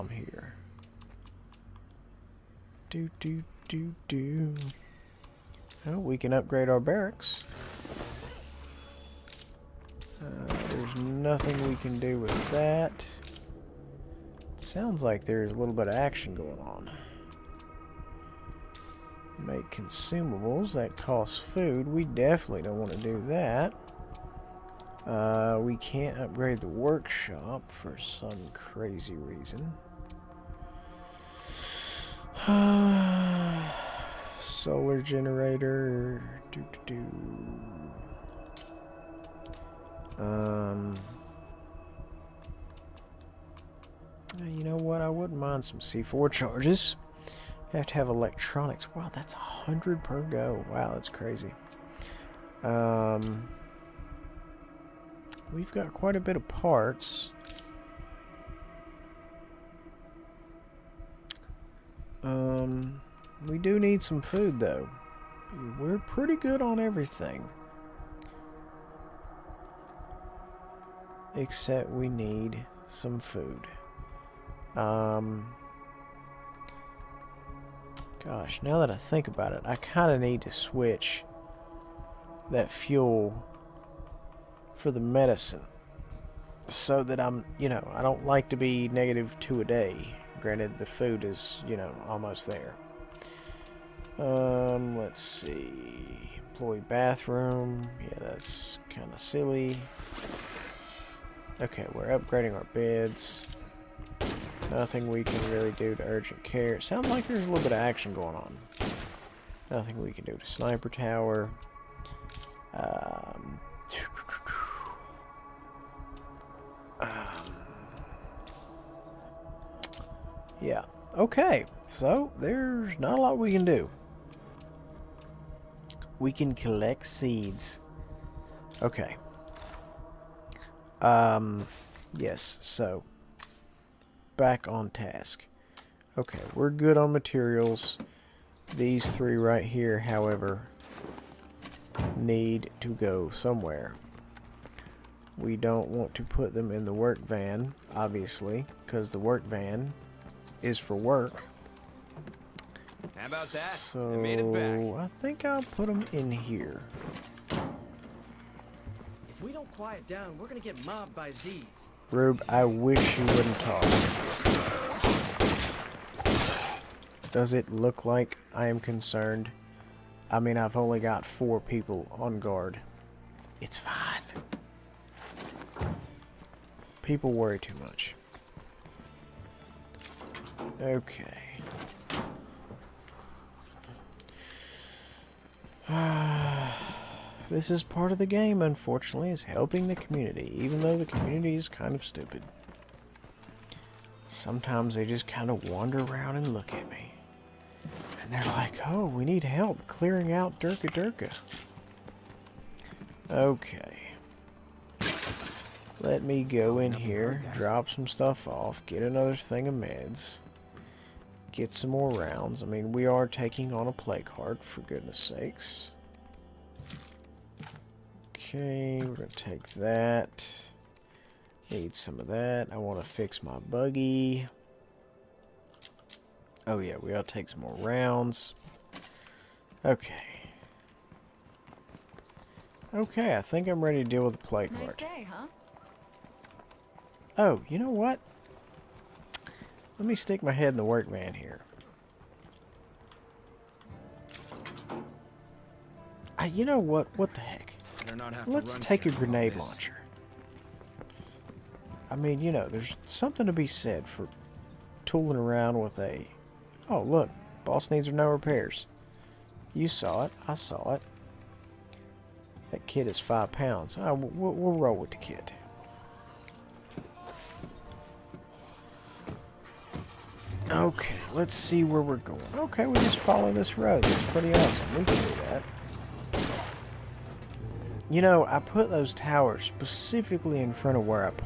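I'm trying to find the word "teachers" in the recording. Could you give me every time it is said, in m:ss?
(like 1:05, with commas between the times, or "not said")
not said.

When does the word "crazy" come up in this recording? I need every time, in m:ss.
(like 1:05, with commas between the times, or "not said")
0:28, 0:51.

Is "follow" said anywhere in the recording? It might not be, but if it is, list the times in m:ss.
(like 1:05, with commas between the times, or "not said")
4:33.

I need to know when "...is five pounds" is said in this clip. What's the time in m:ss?
4:23.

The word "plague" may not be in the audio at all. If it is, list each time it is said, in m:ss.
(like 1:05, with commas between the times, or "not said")
3:33, 3:54.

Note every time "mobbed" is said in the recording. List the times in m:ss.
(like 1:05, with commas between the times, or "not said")
2:40.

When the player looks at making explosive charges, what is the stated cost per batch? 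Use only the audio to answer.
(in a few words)
100.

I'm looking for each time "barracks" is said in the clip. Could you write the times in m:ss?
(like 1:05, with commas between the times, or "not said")
0:06.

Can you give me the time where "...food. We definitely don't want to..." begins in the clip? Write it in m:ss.
0:21.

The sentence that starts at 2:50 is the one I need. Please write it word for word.
I mean, I've only got four people on guard.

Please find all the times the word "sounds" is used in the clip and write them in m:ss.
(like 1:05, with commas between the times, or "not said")
0:14, 1:46.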